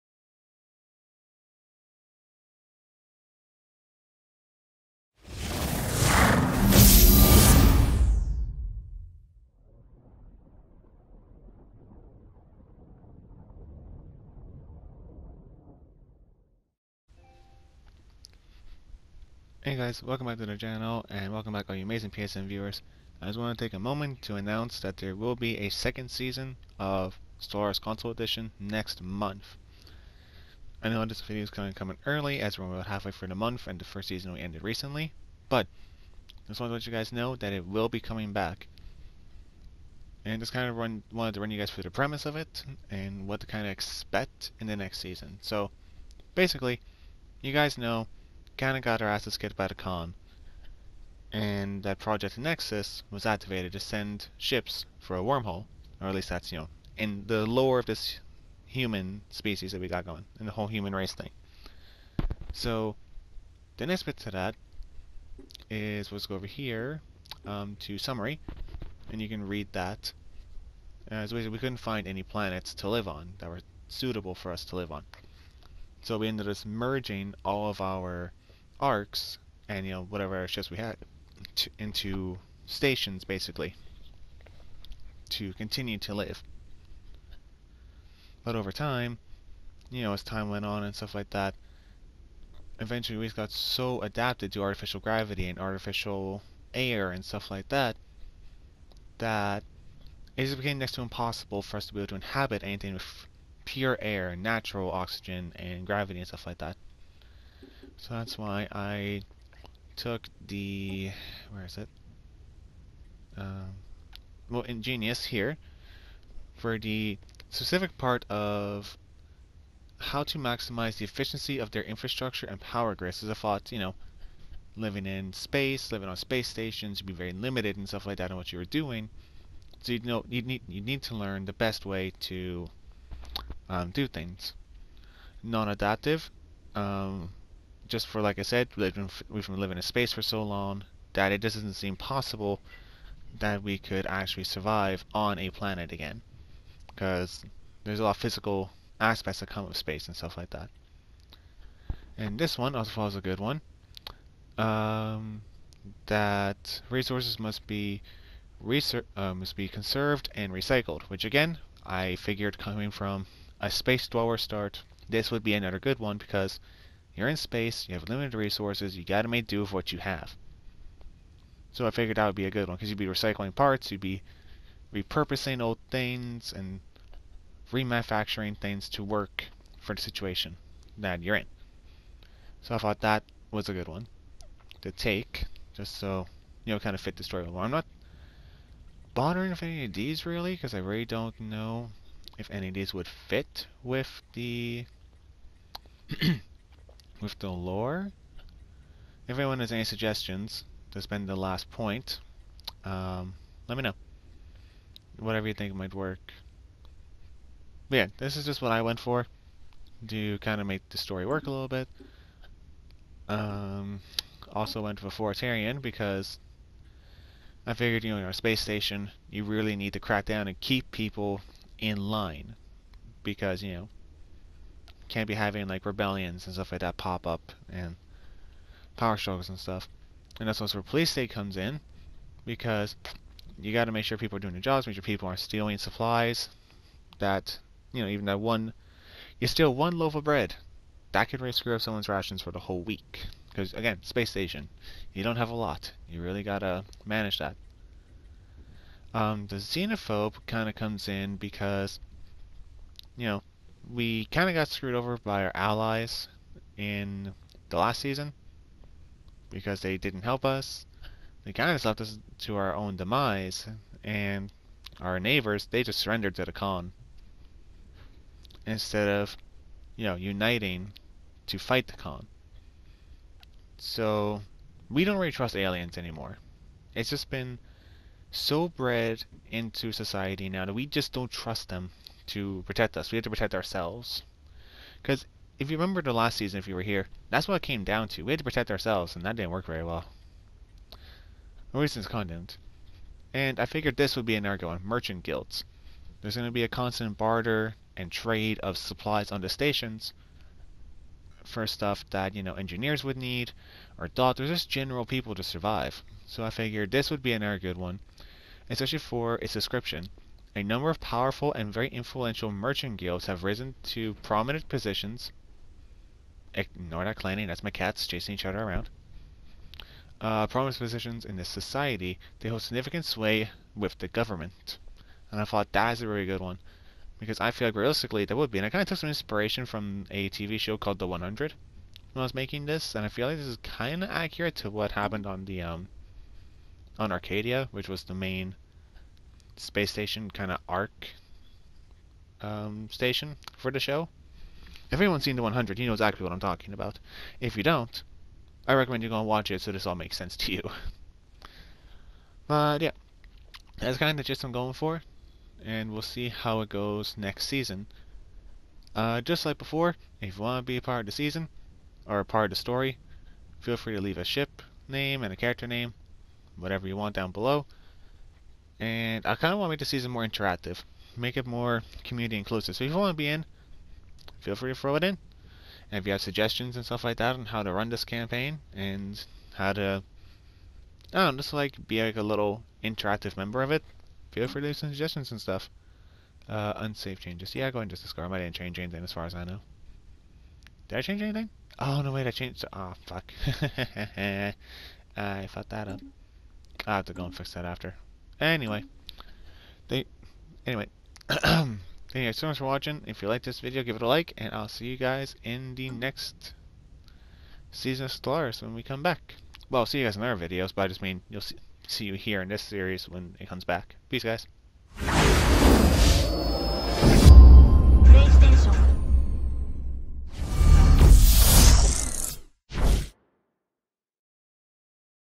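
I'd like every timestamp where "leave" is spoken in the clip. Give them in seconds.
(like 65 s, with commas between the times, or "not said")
364 s, 384 s.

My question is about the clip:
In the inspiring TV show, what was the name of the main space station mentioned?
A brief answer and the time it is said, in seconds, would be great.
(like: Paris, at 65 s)
Arcadia, at 337 s.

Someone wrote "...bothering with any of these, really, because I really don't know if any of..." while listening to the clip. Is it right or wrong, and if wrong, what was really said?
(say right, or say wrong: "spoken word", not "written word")
right.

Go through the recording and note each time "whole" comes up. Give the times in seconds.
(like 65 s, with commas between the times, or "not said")
60 s, 242 s.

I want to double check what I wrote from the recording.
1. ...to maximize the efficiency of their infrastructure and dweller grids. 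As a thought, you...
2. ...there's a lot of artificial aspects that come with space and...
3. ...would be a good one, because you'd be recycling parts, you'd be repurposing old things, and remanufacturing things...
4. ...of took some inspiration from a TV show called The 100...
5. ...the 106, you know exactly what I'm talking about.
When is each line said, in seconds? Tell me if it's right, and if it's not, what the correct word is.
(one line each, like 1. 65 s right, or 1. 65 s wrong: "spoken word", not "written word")
1. 120 s wrong: "power", not "dweller"
2. 147 s wrong: "physical", not "artificial"
3. 172 s right
4. 328 s right
5. 345 s wrong: "100", not "106".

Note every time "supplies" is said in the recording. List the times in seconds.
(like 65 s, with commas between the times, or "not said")
235 s, 298 s.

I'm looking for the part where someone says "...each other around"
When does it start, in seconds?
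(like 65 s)
318 s.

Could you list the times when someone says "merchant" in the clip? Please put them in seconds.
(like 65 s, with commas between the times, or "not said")
294 s, 312 s.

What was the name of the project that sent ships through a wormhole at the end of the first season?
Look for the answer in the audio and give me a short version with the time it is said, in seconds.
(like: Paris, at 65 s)
Project Nexus, at 51 s.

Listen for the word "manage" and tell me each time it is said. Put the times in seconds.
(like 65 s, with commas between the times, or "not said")
247 s.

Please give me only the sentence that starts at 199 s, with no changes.
If anyone has any suggestions to spend the last point, um, let me know.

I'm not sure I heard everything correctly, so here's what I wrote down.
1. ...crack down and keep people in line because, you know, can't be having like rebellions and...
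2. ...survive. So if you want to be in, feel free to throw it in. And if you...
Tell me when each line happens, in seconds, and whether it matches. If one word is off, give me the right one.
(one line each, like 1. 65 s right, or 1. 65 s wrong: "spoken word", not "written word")
1. 219 s right
2. 372 s wrong: "inclusive", not "survive".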